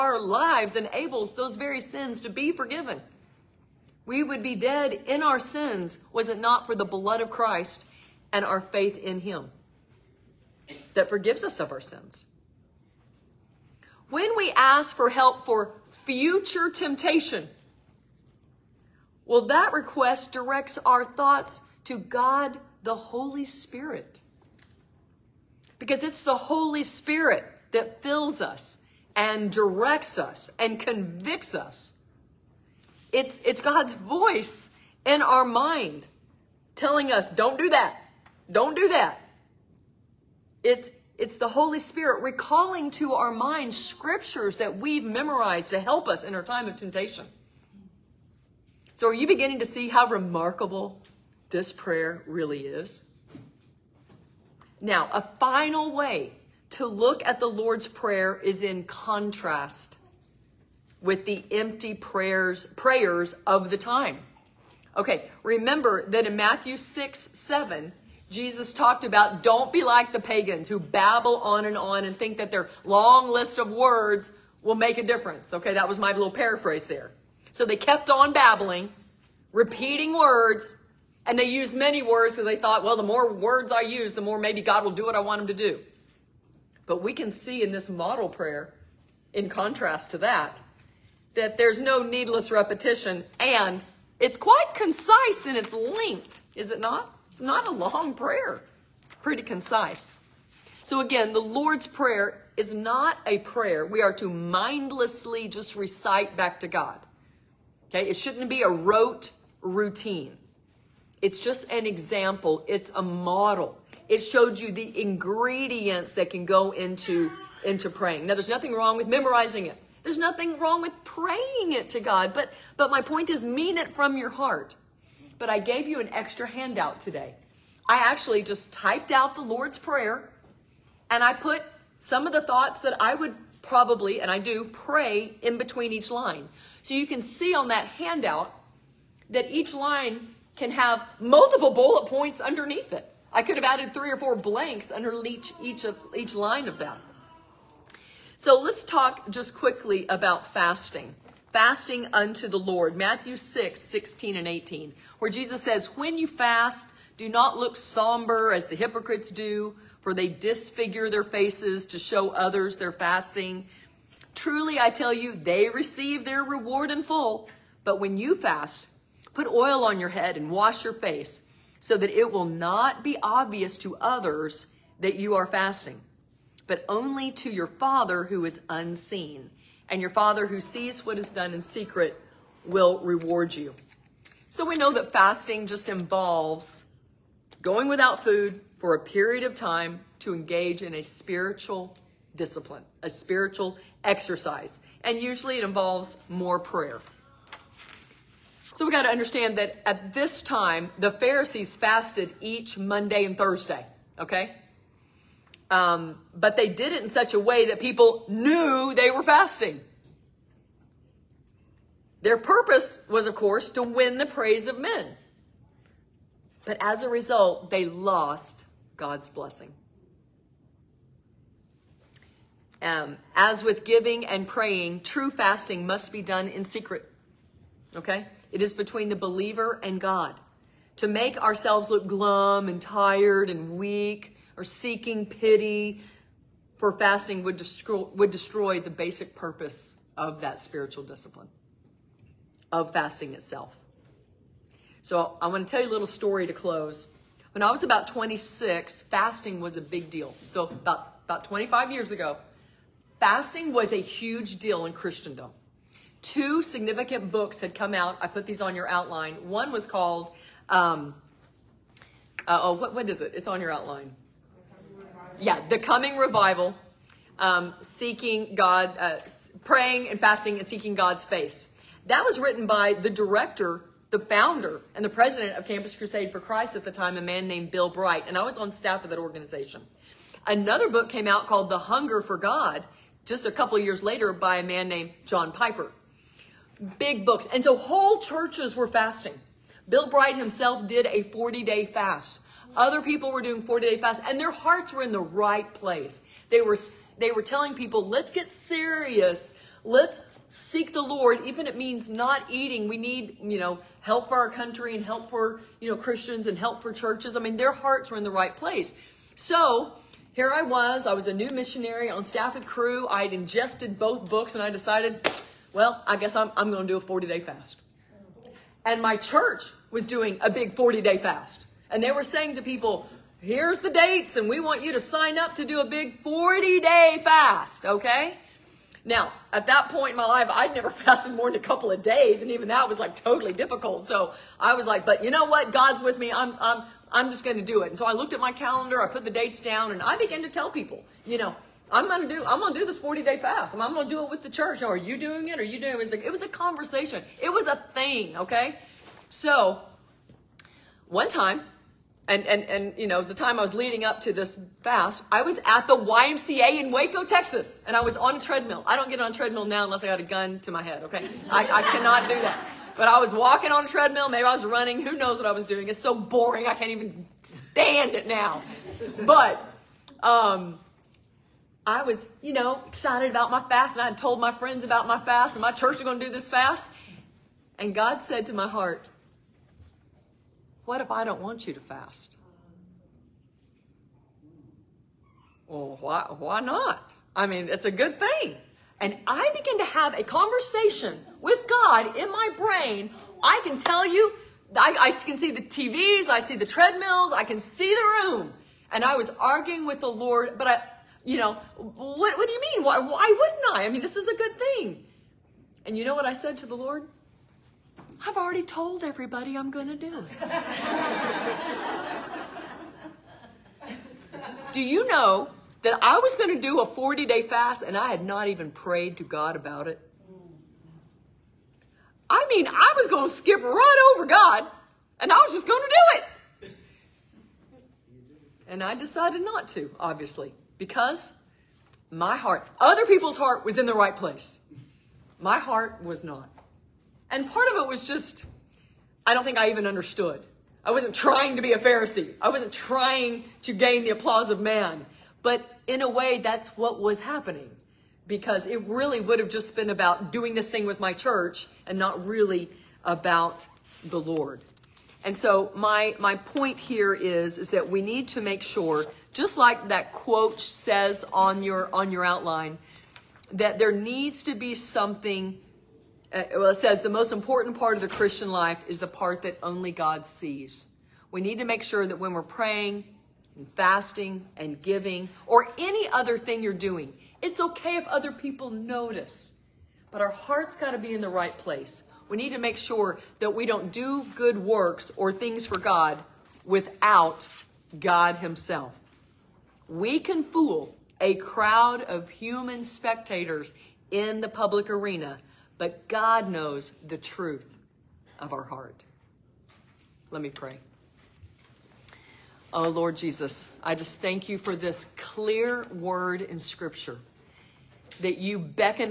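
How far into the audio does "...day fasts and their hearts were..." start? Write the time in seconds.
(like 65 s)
293 s.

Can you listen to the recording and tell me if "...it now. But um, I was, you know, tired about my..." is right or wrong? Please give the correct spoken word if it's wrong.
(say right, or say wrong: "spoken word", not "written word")
wrong: "excited", not "tired".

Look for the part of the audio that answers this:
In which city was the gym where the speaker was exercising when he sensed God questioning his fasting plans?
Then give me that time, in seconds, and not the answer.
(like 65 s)
356 s.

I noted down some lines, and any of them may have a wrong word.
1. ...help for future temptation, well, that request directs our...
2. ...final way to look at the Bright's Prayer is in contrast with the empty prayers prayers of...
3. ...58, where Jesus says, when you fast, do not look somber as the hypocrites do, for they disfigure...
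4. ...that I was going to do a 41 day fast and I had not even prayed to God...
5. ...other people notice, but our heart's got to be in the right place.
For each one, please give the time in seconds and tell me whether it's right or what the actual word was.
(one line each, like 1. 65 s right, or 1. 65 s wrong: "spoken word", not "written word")
1. 15 s right
2. 55 s wrong: "Lord", not "Bright"
3. 154 s wrong: "18", not "58"
4. 415 s wrong: "40", not "41"
5. 478 s right.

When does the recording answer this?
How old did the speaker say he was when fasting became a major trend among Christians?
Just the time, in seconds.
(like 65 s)
248 s.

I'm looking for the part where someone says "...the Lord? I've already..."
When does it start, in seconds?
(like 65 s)
406 s.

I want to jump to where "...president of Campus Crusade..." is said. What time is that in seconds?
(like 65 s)
275 s.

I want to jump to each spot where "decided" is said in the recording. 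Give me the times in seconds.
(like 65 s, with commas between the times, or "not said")
314 s, 428 s.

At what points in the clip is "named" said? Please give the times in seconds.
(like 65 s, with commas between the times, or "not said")
277 s, 284 s.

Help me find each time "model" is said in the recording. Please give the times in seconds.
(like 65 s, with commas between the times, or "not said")
87 s, 113 s.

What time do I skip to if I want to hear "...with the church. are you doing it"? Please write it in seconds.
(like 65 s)
344 s.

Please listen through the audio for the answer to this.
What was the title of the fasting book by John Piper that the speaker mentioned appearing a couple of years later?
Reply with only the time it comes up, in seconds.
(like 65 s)
281 s.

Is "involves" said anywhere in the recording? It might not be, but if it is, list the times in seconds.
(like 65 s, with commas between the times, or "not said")
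185 s, 195 s.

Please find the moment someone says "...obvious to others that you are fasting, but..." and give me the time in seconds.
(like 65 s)
173 s.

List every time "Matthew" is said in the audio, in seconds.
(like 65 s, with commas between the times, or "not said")
66 s, 152 s.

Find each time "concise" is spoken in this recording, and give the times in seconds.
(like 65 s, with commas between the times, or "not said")
94 s, 99 s.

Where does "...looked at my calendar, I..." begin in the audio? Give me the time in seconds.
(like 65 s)
338 s.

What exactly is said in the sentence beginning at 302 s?
We need, you know, help for our country and help for, you know, Christians and help for churches.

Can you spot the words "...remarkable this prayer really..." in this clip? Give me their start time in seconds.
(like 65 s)
50 s.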